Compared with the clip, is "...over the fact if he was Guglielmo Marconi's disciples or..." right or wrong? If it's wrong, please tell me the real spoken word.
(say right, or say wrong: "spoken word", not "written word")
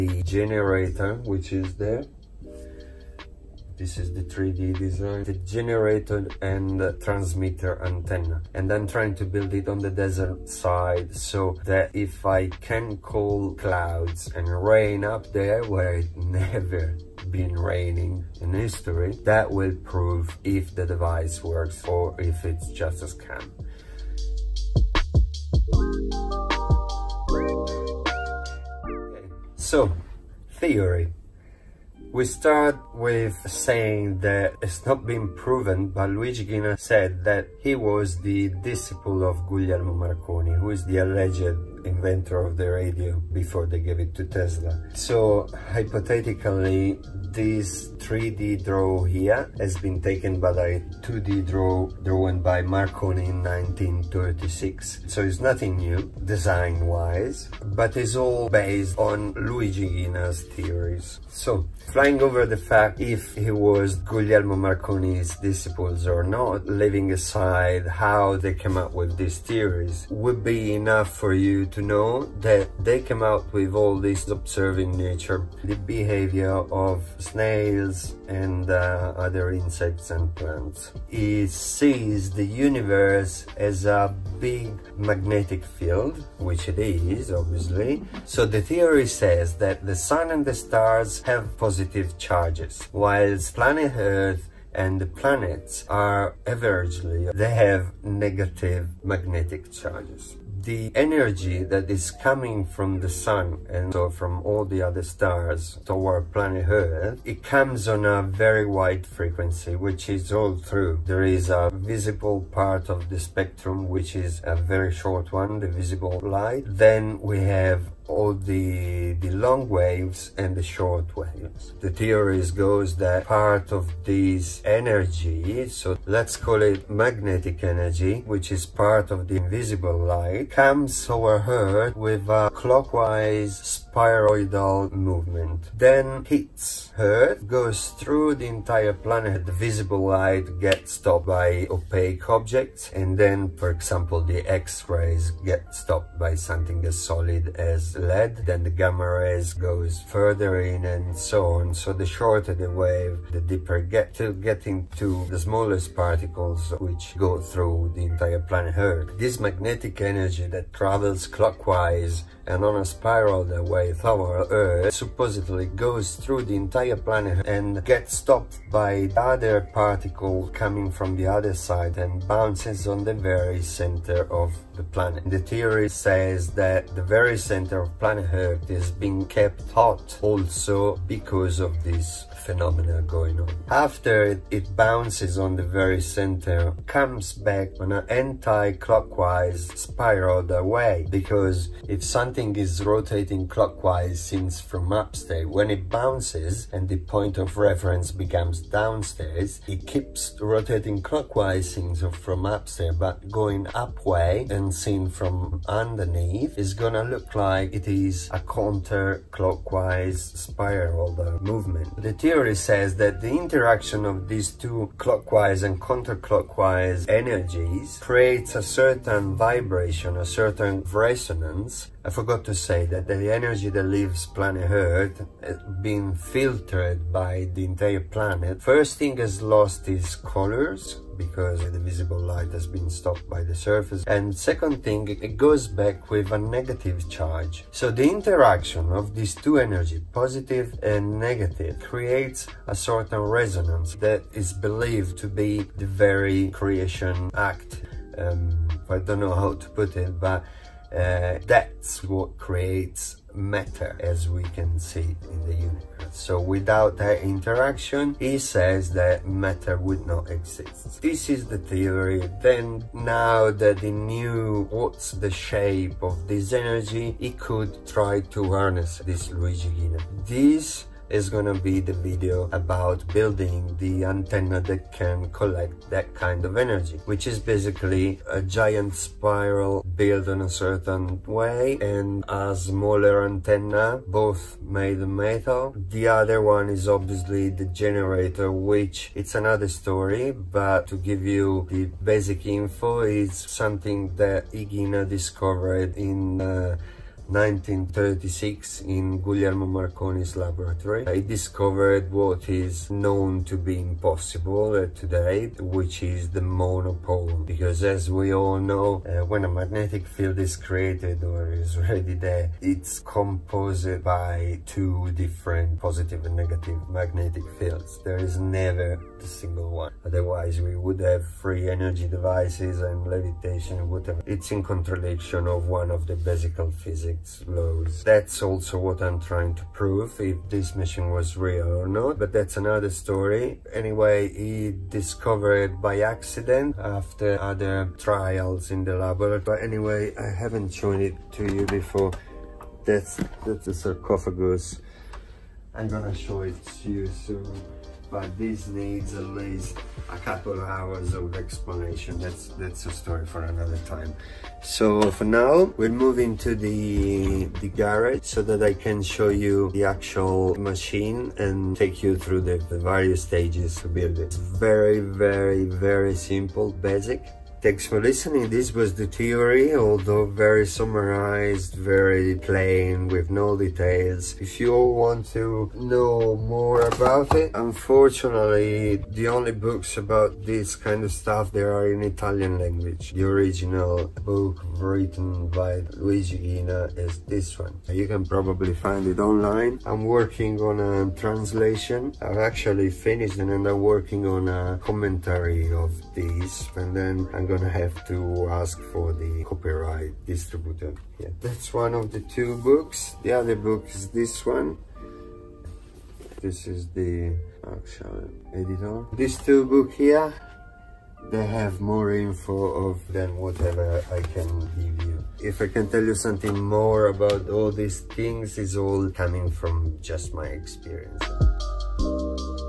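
right.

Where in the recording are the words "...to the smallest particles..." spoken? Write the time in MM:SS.
02:34.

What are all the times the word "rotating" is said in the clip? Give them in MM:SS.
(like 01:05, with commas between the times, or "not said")
03:12, 03:20.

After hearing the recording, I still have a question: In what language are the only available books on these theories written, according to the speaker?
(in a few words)
Italian.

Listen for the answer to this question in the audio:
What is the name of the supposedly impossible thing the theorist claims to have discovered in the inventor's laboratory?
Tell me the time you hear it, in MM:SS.
05:06.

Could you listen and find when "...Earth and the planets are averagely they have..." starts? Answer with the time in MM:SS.
01:33.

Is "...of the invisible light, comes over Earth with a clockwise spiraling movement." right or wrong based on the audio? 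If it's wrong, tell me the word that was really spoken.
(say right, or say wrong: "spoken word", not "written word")
right.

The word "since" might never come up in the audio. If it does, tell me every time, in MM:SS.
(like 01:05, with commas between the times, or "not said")
03:14, 03:21.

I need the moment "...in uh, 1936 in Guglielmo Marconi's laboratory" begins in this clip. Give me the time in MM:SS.
04:55.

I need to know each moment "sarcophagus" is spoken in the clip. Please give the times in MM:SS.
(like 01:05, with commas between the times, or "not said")
05:43.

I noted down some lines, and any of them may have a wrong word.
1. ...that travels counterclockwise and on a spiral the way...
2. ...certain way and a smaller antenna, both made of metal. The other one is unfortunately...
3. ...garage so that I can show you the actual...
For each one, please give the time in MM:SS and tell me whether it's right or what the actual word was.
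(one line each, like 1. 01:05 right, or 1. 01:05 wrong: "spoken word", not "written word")
1. 02:40 wrong: "clockwise", not "counterclockwise"
2. 04:40 wrong: "obviously", not "unfortunately"
3. 05:57 right.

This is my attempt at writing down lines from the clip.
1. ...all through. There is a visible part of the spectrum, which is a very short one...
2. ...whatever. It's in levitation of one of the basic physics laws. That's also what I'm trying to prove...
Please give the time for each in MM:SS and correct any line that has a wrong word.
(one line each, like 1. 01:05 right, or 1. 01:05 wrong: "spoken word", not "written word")
1. 01:50 right
2. 05:23 wrong: "contradiction", not "levitation".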